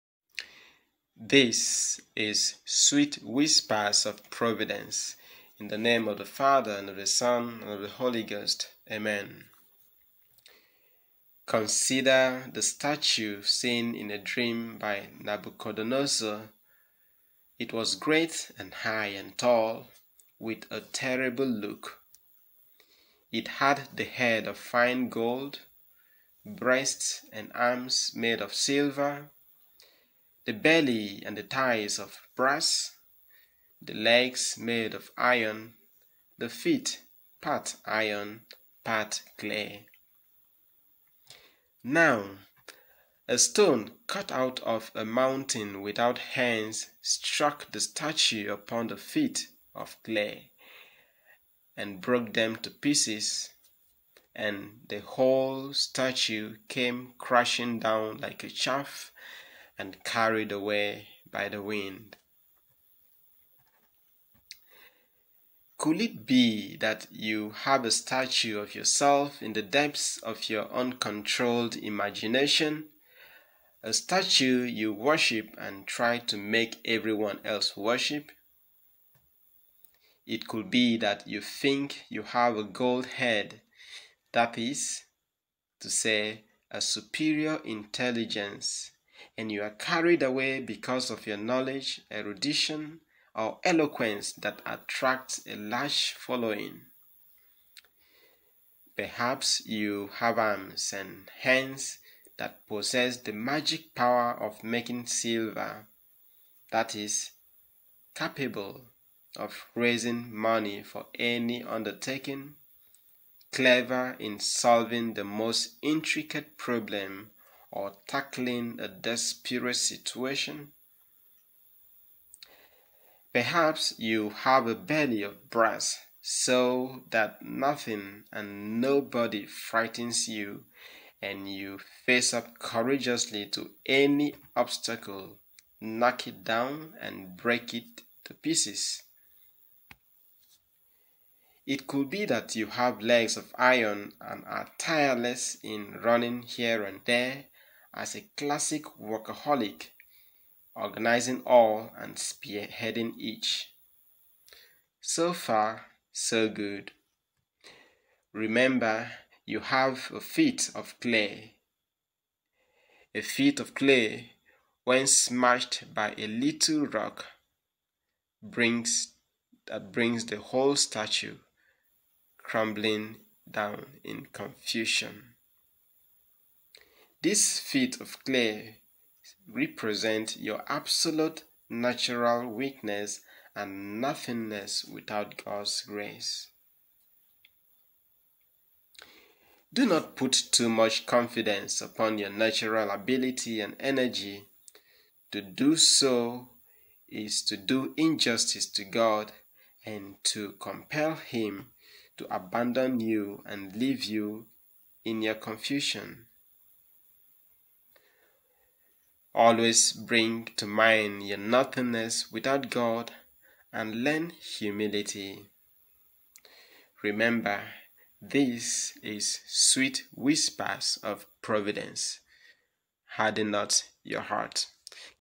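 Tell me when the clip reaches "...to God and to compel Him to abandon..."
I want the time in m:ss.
3:18.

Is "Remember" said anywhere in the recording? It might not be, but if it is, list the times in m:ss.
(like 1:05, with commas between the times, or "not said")
2:38, 3:37.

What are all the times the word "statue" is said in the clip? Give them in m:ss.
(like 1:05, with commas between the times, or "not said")
0:12, 0:47, 0:55, 1:07, 1:13, 2:50.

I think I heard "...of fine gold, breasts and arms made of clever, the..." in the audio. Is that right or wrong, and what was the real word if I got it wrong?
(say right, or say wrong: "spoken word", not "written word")
wrong: "silver", not "clever".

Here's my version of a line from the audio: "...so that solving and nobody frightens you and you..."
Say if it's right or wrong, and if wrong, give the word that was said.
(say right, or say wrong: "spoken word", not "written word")
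wrong: "nothing", not "solving".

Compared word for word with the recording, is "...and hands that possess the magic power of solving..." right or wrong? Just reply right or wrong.
wrong.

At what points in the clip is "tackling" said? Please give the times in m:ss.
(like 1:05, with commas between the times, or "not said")
1:58.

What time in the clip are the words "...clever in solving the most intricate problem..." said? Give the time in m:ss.
1:53.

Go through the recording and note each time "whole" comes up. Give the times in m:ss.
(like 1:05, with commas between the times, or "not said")
0:55, 2:50.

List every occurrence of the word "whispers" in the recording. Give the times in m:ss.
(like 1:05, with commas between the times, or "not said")
0:03, 3:40.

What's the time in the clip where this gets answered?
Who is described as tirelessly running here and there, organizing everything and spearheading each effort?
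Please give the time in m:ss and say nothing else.
2:28.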